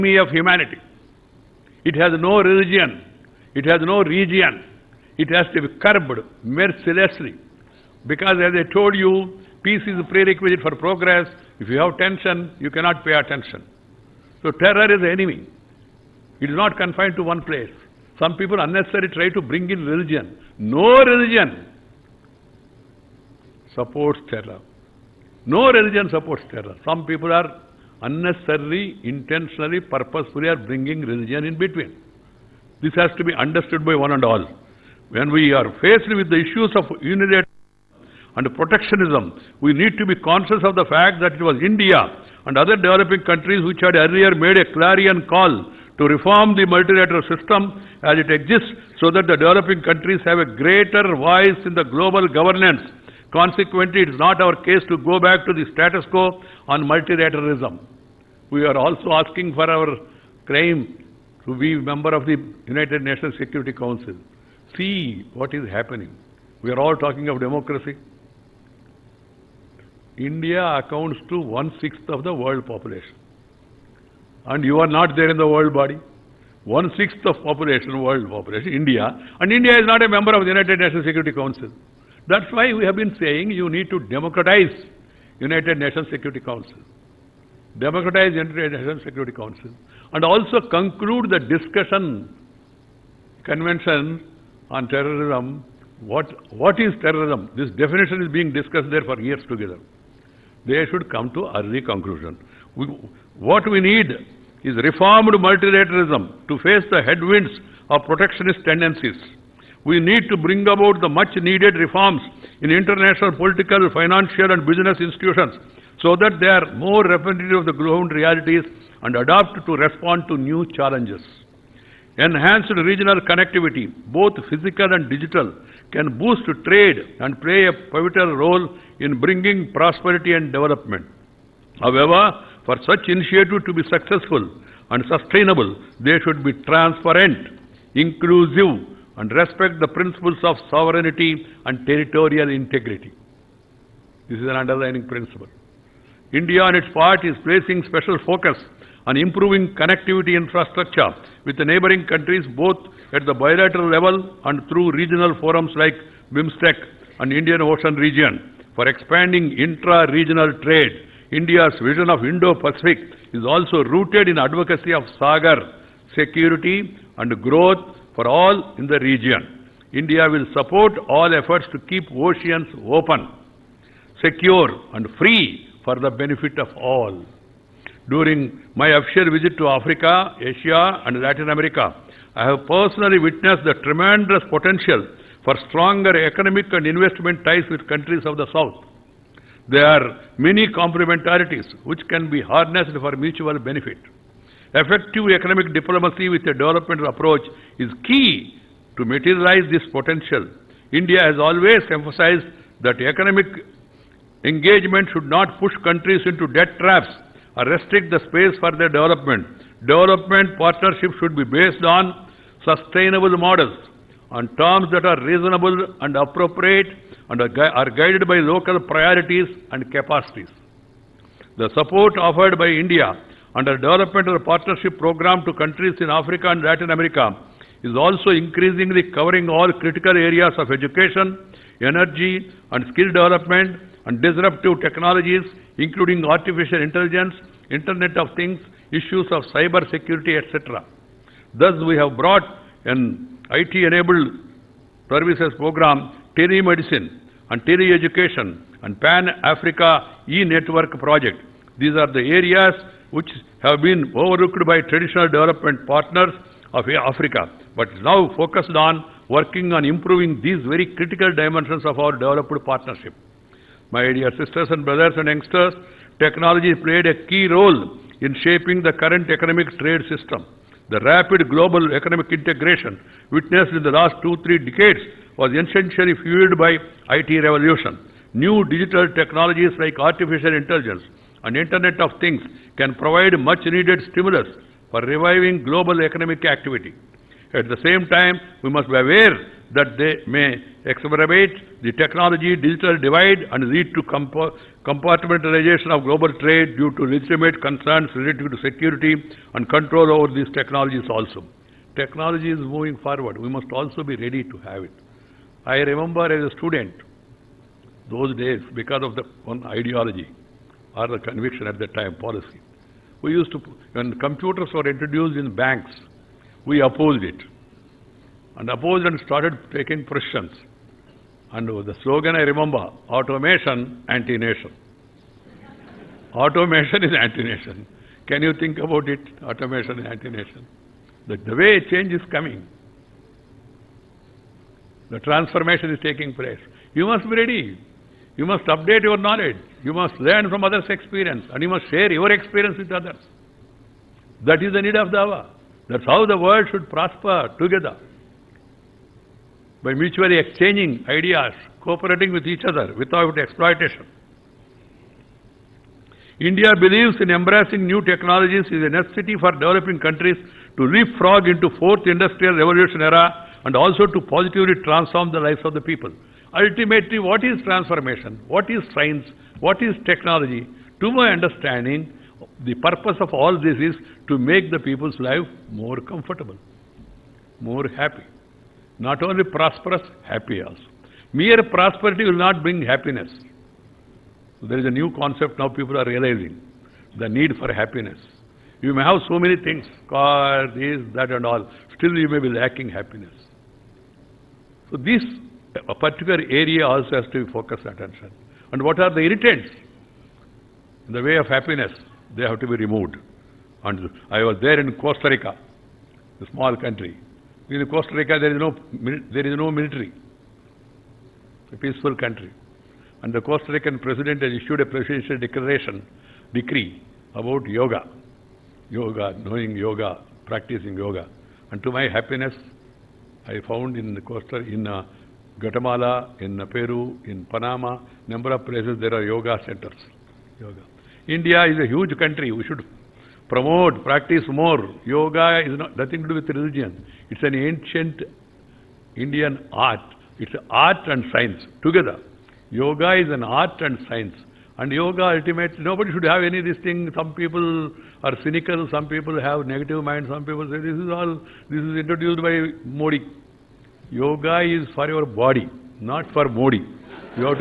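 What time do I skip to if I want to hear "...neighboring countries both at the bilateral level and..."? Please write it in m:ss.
2:31.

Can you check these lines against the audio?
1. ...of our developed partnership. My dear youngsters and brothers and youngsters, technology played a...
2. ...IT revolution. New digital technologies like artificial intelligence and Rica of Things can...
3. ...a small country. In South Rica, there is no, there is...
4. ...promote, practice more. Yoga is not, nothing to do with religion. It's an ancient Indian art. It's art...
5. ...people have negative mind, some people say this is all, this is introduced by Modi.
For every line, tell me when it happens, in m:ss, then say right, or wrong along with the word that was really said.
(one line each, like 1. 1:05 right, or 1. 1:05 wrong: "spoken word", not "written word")
1. 4:21 wrong: "sisters", not "youngsters"
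2. 4:37 wrong: "Internet", not "Rica"
3. 6:46 wrong: "Costa", not "South"
4. 7:13 right
5. 7:29 right.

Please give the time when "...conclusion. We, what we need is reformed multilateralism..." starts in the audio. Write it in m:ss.
1:41.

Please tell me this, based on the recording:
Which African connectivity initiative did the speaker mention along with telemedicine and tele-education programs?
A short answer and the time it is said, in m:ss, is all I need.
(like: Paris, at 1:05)
Pan-Africa e-network project, at 4:08.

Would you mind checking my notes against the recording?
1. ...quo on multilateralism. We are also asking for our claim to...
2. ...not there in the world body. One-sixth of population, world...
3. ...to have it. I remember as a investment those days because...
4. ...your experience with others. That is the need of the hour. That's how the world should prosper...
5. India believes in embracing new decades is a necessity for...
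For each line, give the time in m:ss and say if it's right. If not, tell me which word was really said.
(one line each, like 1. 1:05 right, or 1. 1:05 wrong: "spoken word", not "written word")
1. 0:56 right
2. 1:14 right
3. 5:04 wrong: "student", not "investment"
4. 5:42 right
5. 5:56 wrong: "technologies", not "decades".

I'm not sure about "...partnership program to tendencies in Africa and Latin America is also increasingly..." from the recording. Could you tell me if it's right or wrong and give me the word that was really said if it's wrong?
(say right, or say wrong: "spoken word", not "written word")
wrong: "countries", not "tendencies".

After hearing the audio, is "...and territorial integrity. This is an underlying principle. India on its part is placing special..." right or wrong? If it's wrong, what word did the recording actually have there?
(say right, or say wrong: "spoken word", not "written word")
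right.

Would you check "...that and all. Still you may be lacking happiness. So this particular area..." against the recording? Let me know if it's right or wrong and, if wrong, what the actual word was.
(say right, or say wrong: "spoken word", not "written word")
right.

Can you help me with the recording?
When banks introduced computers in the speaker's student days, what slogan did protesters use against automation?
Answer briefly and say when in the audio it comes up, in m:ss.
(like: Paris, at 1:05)
Automation, anti-nation, at 5:23.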